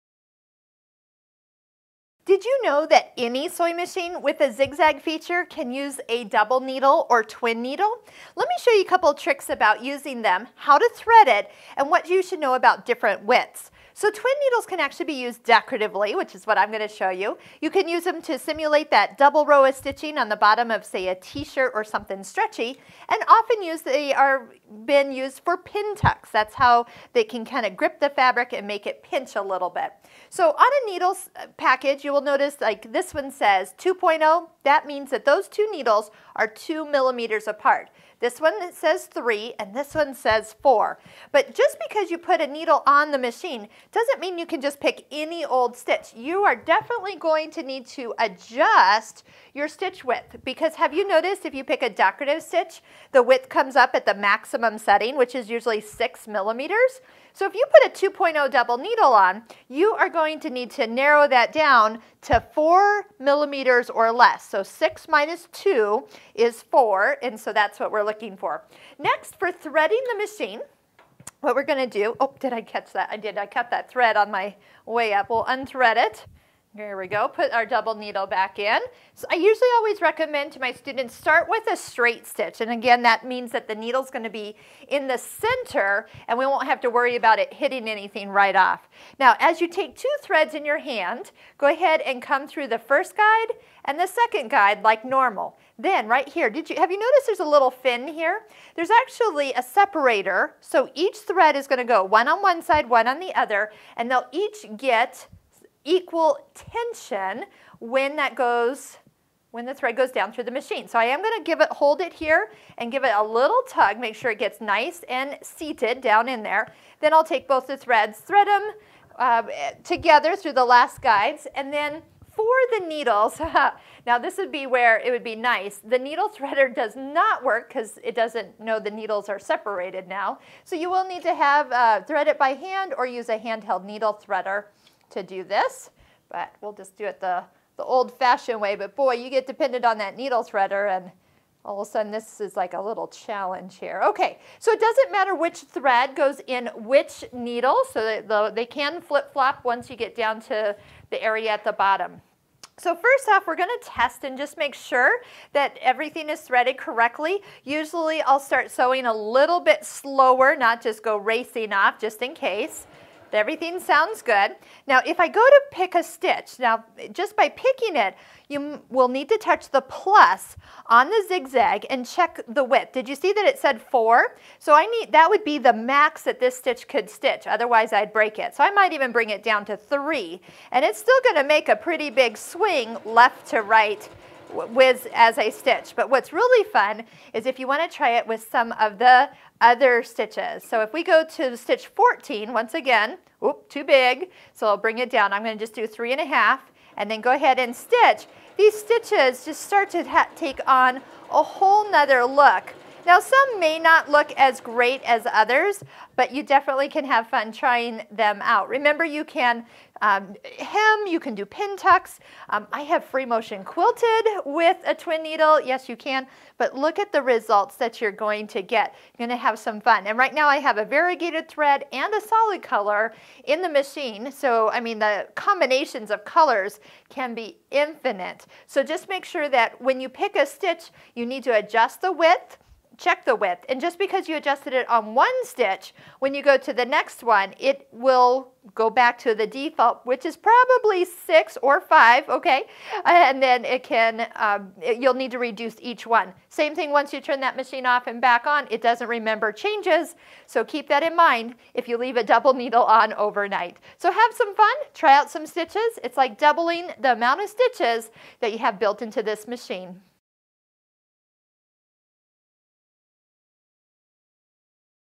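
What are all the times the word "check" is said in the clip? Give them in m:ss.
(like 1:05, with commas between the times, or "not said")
2:52, 3:53.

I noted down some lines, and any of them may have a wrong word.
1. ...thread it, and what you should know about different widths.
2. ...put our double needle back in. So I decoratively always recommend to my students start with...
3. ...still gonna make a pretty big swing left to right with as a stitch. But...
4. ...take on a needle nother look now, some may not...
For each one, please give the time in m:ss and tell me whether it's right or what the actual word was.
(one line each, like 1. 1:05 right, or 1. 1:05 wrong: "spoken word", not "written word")
1. 0:10 right
2. 1:17 wrong: "usually", not "decoratively"
3. 3:00 right
4. 3:20 wrong: "whole", not "needle".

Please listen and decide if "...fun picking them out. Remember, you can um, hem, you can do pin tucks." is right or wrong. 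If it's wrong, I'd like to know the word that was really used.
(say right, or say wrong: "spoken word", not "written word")
wrong: "trying", not "picking".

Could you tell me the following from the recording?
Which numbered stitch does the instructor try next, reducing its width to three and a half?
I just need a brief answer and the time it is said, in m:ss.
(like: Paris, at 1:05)
14, at 3:11.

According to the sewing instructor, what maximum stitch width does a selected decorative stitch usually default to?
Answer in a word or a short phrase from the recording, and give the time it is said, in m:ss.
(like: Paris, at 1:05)
6 millimeters, at 0:55.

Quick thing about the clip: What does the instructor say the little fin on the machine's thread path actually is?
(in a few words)
a separator.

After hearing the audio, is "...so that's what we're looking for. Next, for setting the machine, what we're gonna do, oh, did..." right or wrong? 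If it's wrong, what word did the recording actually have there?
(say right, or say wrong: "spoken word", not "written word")
wrong: "threading", not "setting".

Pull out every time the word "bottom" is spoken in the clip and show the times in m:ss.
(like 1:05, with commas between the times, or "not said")
0:20, 2:31.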